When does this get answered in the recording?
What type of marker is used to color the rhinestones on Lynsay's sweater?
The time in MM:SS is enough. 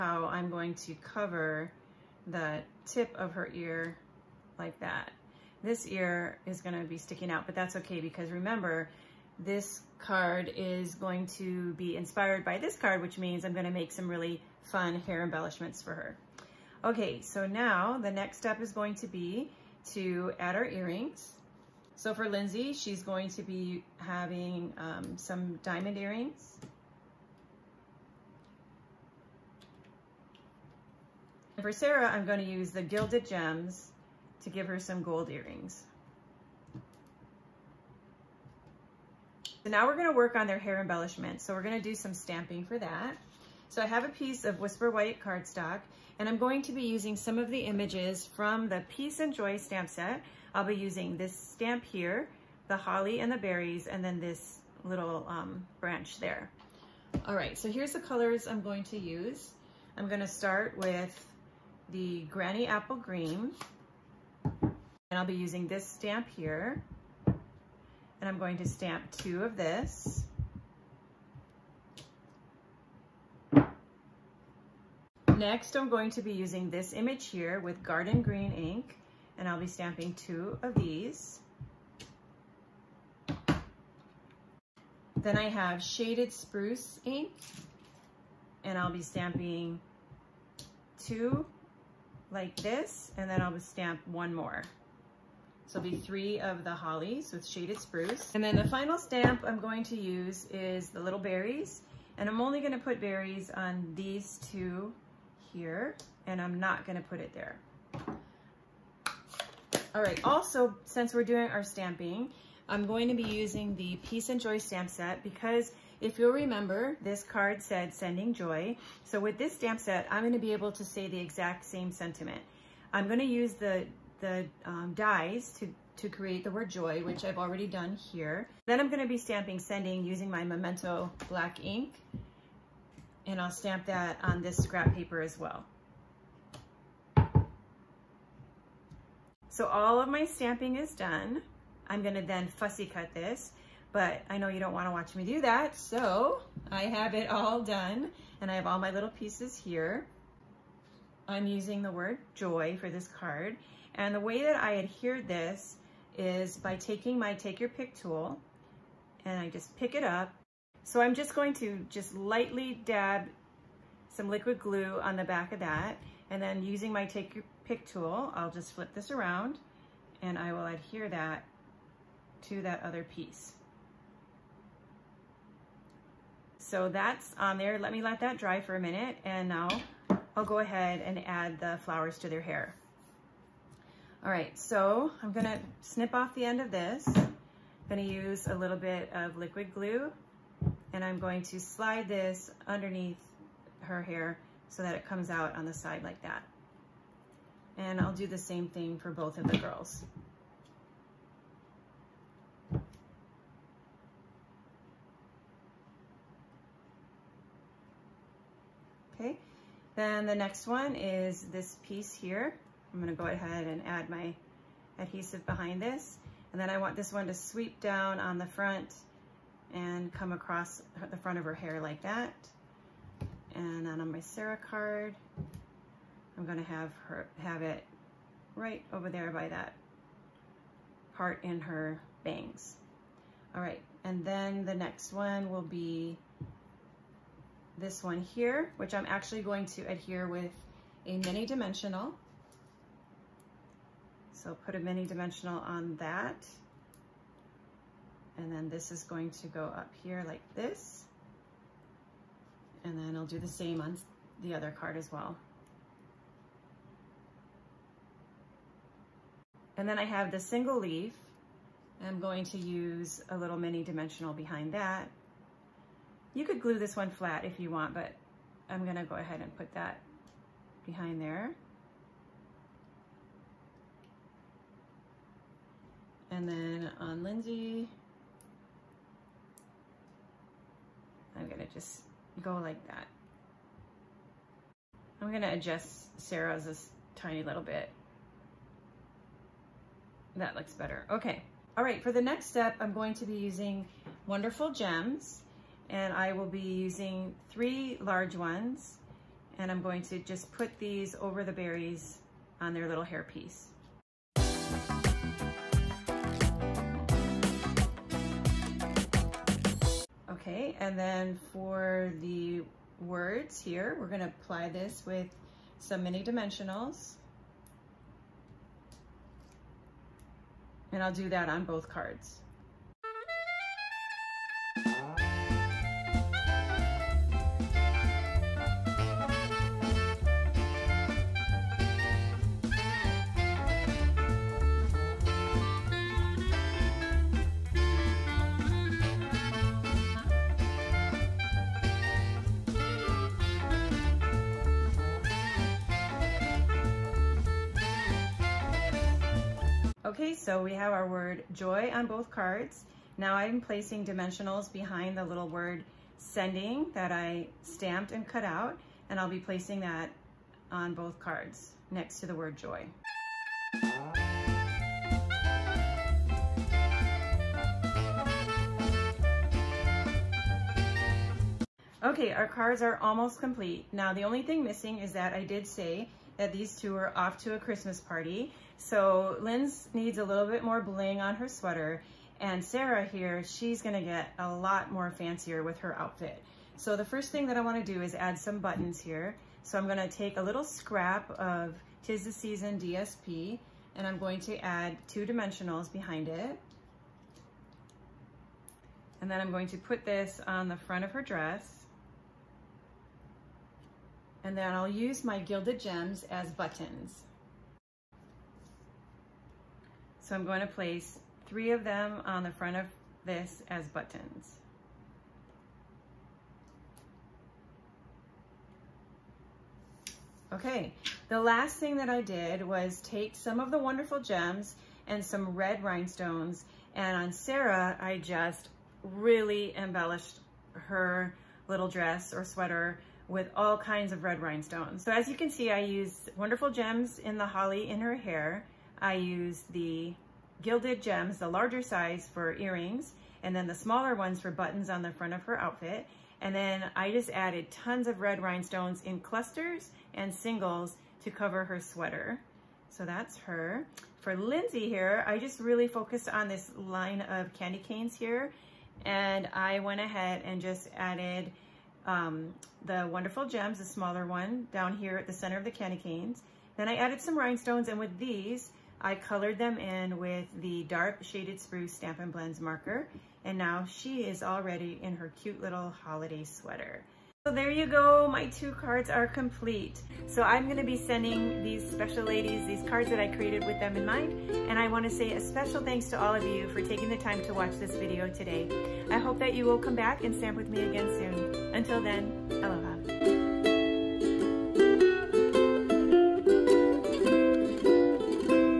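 07:51.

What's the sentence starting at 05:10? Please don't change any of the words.
Okay, and then for the words here, we're gonna apply this with some mini dimensionals.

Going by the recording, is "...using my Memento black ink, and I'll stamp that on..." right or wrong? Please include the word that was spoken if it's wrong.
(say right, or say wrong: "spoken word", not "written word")
right.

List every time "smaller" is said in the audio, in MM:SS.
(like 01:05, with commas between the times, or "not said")
07:23, 07:43.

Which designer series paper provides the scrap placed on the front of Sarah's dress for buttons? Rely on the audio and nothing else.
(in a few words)
Tis the Season.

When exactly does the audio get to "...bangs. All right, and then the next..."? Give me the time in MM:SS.
03:52.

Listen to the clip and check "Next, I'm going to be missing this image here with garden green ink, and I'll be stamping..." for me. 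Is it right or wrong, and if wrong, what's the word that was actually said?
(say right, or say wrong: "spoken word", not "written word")
wrong: "using", not "missing".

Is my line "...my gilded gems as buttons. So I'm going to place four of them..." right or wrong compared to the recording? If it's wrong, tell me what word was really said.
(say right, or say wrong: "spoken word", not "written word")
wrong: "three", not "four".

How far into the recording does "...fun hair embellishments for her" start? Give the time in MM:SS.
00:14.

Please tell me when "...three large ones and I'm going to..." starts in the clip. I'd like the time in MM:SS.
04:57.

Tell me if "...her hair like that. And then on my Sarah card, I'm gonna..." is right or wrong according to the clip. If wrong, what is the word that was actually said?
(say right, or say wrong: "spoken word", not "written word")
right.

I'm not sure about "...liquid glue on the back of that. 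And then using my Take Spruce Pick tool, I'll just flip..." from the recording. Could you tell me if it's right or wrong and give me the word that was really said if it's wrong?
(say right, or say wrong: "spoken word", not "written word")
wrong: "Your", not "Spruce".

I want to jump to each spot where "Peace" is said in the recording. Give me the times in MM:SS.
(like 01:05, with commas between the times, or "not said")
00:48, 01:54.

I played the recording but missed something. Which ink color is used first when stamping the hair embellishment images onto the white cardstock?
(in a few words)
Granny Apple Green.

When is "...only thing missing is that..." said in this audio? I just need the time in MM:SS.
06:14.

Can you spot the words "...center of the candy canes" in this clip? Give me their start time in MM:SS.
07:45.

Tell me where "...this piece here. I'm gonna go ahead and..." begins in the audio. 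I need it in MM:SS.
03:31.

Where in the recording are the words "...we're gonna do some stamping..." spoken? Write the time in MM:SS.
00:41.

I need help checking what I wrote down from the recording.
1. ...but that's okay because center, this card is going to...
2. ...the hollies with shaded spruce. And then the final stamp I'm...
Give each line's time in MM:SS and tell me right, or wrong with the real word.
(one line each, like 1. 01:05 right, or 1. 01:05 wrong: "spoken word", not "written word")
1. 00:07 wrong: "remember", not "center"
2. 01:36 right.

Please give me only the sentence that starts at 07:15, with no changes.
So as you can see, I used wonderful gems in the holly in her hair.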